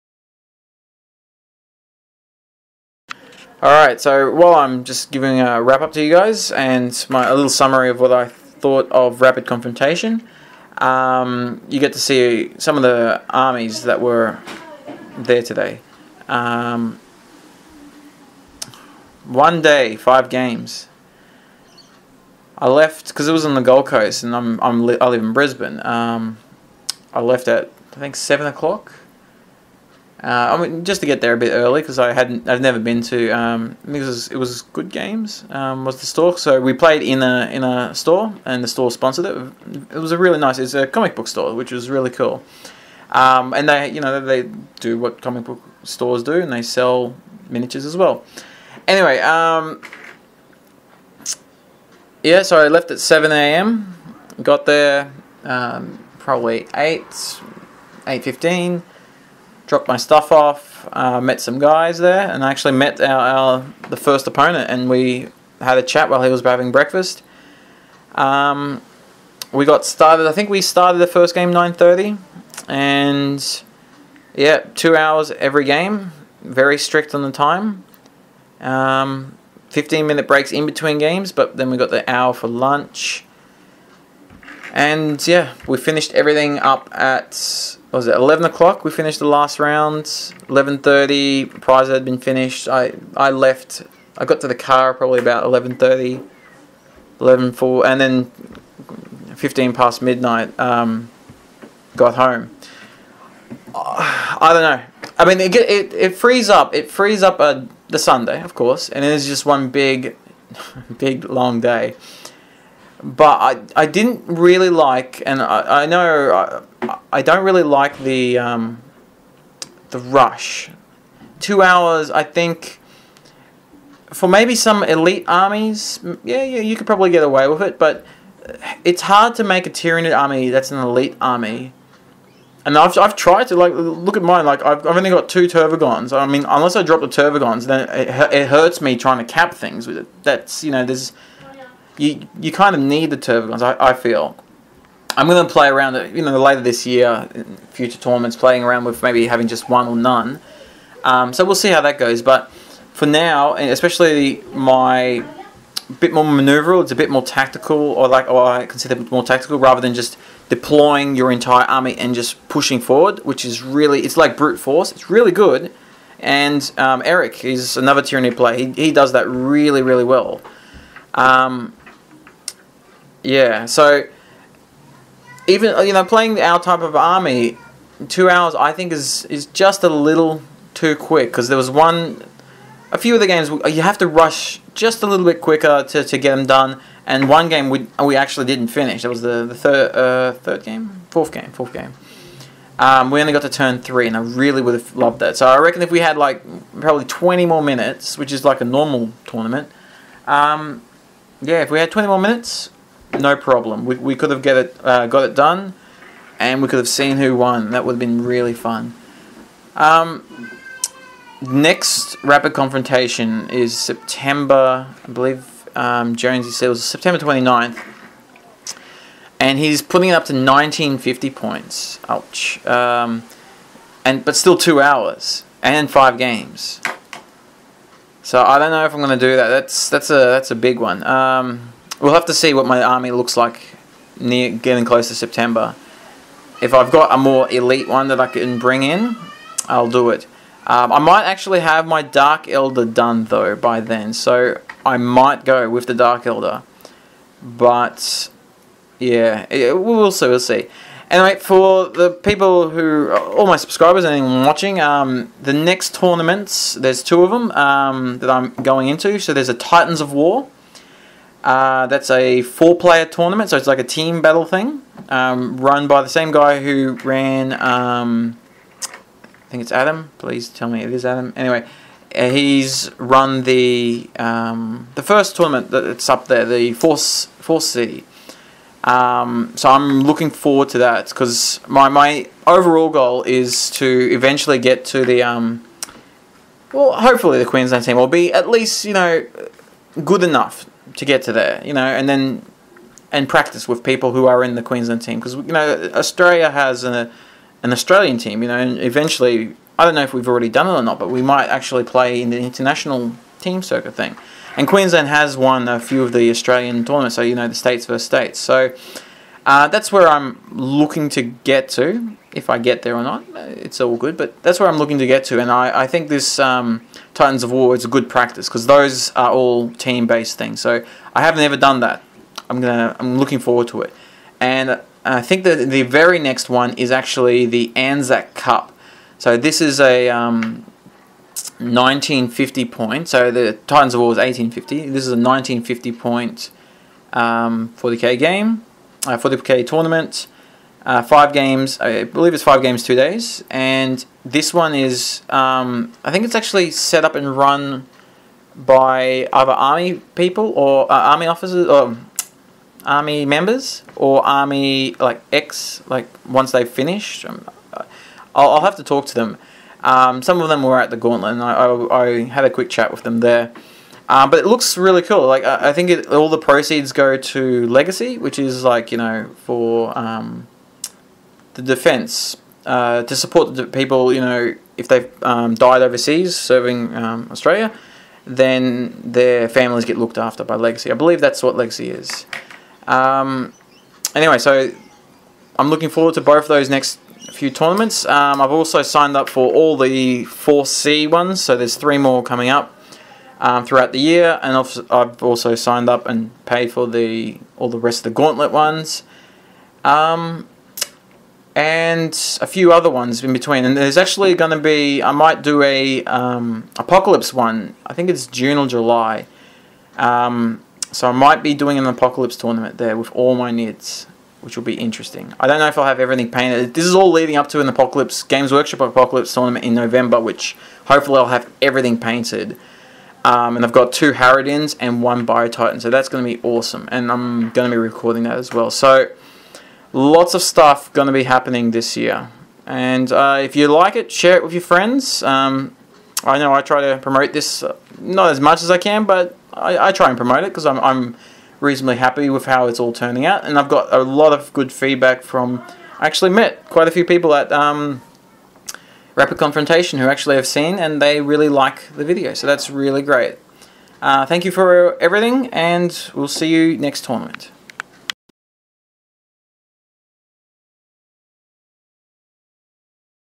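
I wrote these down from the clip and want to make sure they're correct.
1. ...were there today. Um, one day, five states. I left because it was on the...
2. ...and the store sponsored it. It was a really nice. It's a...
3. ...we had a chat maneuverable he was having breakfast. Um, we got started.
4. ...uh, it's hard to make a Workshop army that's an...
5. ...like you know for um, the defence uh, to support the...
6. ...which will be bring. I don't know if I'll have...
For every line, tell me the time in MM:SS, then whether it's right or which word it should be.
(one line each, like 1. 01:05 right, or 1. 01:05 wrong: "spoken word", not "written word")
1. 00:14 wrong: "games", not "states"
2. 00:38 right
3. 01:04 wrong: "while", not "maneuverable"
4. 02:08 wrong: "Tyranid", not "Workshop"
5. 06:08 right
6. 06:54 wrong: "interesting", not "bring".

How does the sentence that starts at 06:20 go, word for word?
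I believe that's what legacy is.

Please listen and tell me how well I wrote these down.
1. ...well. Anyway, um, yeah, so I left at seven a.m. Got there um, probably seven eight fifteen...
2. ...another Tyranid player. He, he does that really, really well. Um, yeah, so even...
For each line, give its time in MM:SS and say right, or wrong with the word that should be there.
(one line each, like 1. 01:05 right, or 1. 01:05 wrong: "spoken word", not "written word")
1. 00:47 wrong: "eight", not "seven"
2. 02:47 right.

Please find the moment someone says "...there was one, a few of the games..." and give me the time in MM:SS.
03:01.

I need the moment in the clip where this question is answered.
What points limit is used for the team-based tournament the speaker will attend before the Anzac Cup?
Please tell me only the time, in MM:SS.
05:34.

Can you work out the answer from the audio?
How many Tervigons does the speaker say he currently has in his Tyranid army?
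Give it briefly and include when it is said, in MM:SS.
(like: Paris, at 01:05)
2, at 02:15.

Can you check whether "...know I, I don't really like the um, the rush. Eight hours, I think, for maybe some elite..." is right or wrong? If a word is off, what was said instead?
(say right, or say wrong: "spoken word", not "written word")
wrong: "Two", not "Eight".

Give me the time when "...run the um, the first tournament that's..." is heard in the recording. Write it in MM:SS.
04:32.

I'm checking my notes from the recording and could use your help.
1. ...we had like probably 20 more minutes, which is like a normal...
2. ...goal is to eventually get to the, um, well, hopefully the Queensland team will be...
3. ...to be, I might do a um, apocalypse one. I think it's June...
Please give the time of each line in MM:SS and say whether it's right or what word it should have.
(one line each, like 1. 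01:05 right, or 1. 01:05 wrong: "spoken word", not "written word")
1. 03:15 right
2. 04:42 right
3. 06:44 right.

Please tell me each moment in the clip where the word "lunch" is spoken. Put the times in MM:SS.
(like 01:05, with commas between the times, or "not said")
01:22.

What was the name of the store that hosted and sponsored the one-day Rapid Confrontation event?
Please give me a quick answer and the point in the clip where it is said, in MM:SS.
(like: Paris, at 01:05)
Good Games, at 00:34.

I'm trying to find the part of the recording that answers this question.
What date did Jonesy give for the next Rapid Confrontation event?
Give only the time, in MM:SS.
03:36.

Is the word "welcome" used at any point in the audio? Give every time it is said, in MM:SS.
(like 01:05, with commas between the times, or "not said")
not said.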